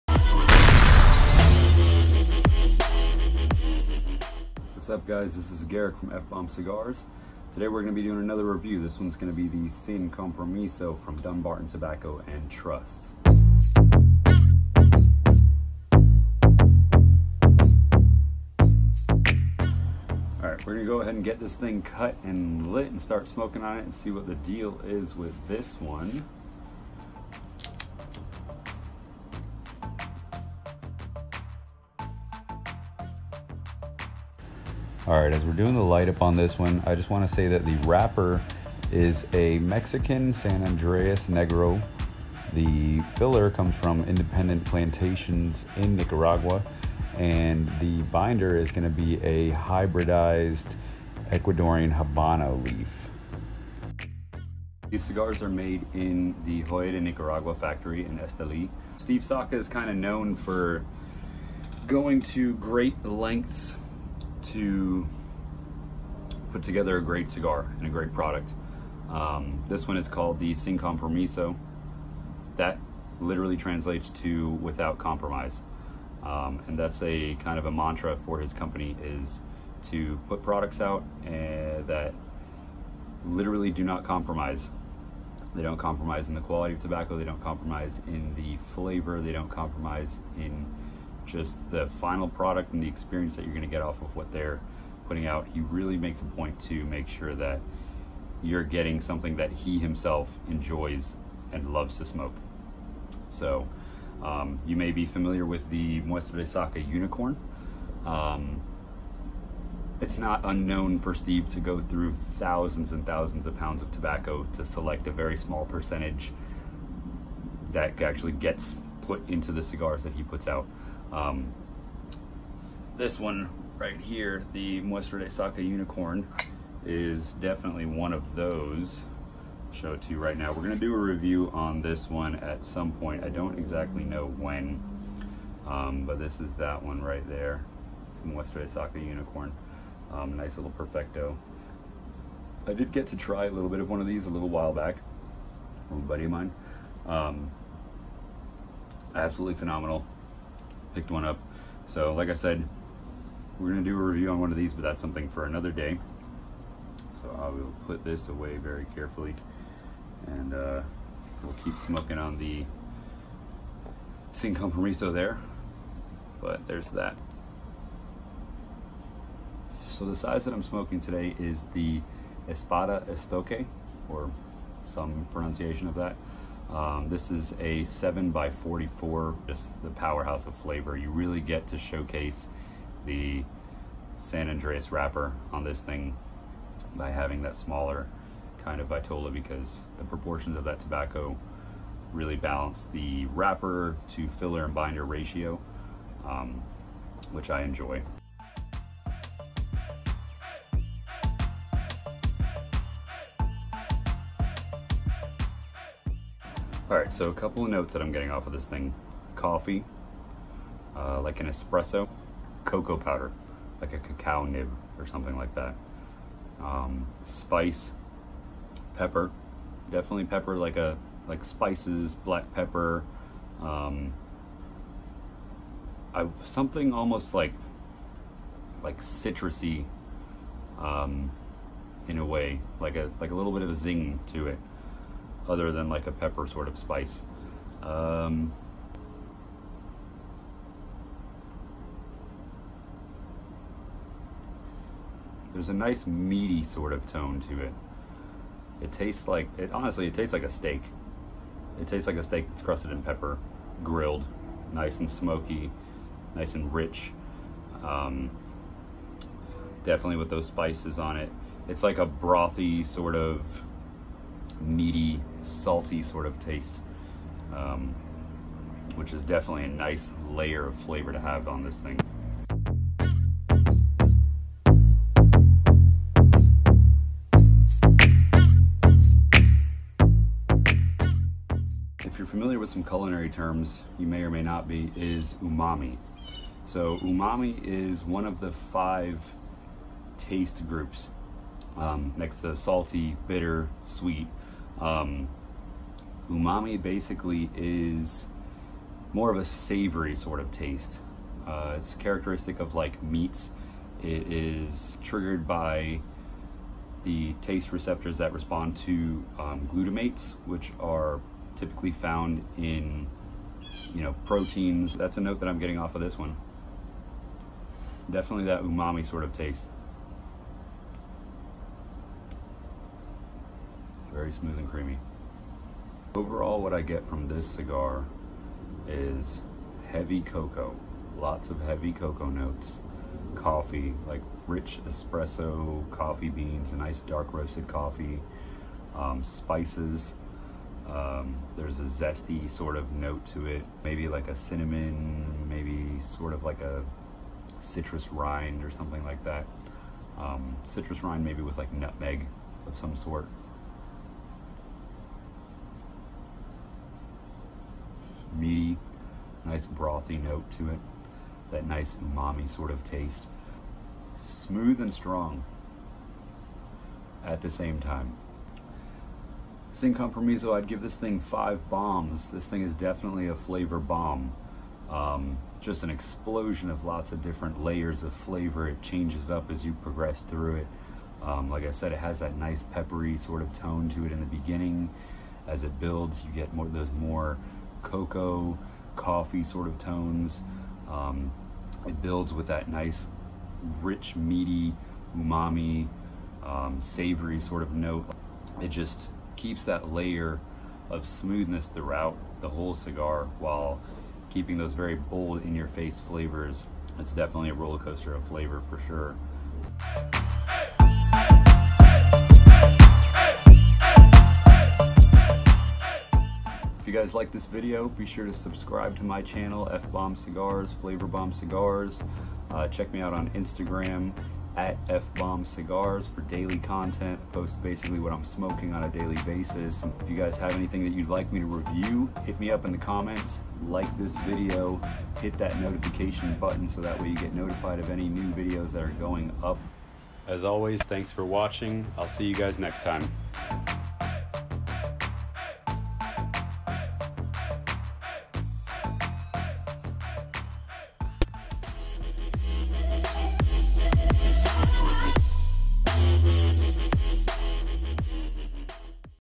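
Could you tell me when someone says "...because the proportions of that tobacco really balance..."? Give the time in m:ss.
3:09.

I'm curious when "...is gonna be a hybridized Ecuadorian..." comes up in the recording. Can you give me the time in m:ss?
0:48.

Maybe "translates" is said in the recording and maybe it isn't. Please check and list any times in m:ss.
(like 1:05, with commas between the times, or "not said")
1:13.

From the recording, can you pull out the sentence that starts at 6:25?
As it builds, you get more those more cocoa, coffee sort of tones.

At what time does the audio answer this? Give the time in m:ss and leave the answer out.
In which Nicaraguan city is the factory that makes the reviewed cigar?
0:58.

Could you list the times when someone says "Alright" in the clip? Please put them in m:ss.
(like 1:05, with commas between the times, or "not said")
0:20, 3:26.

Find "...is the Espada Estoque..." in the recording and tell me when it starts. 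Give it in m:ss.
2:51.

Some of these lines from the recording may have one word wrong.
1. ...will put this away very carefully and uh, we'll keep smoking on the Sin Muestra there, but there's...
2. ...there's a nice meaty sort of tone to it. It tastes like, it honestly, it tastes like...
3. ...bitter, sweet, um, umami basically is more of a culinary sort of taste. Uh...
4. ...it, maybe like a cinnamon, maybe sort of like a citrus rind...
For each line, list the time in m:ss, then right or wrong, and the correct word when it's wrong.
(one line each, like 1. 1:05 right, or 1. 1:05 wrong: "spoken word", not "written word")
1. 2:37 wrong: "Compromiso", not "Muestra"
2. 4:05 right
3. 4:53 wrong: "savory", not "culinary"
4. 5:43 right.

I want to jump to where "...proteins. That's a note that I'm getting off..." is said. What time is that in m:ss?
5:14.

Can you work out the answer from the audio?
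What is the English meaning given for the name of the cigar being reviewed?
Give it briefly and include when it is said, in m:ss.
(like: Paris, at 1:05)
Without compromise, at 1:14.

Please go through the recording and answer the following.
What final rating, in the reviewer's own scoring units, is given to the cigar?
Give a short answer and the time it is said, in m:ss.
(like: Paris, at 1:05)
5 bombs, at 6:11.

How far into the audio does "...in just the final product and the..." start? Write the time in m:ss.
1:30.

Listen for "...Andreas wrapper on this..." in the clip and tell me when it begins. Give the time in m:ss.
3:04.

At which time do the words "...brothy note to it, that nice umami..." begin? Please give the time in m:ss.
5:59.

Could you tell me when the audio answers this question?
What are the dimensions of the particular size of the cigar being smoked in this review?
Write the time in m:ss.
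2:57.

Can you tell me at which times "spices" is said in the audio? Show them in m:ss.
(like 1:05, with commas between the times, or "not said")
3:37, 3:41, 3:56, 4:20, 5:39.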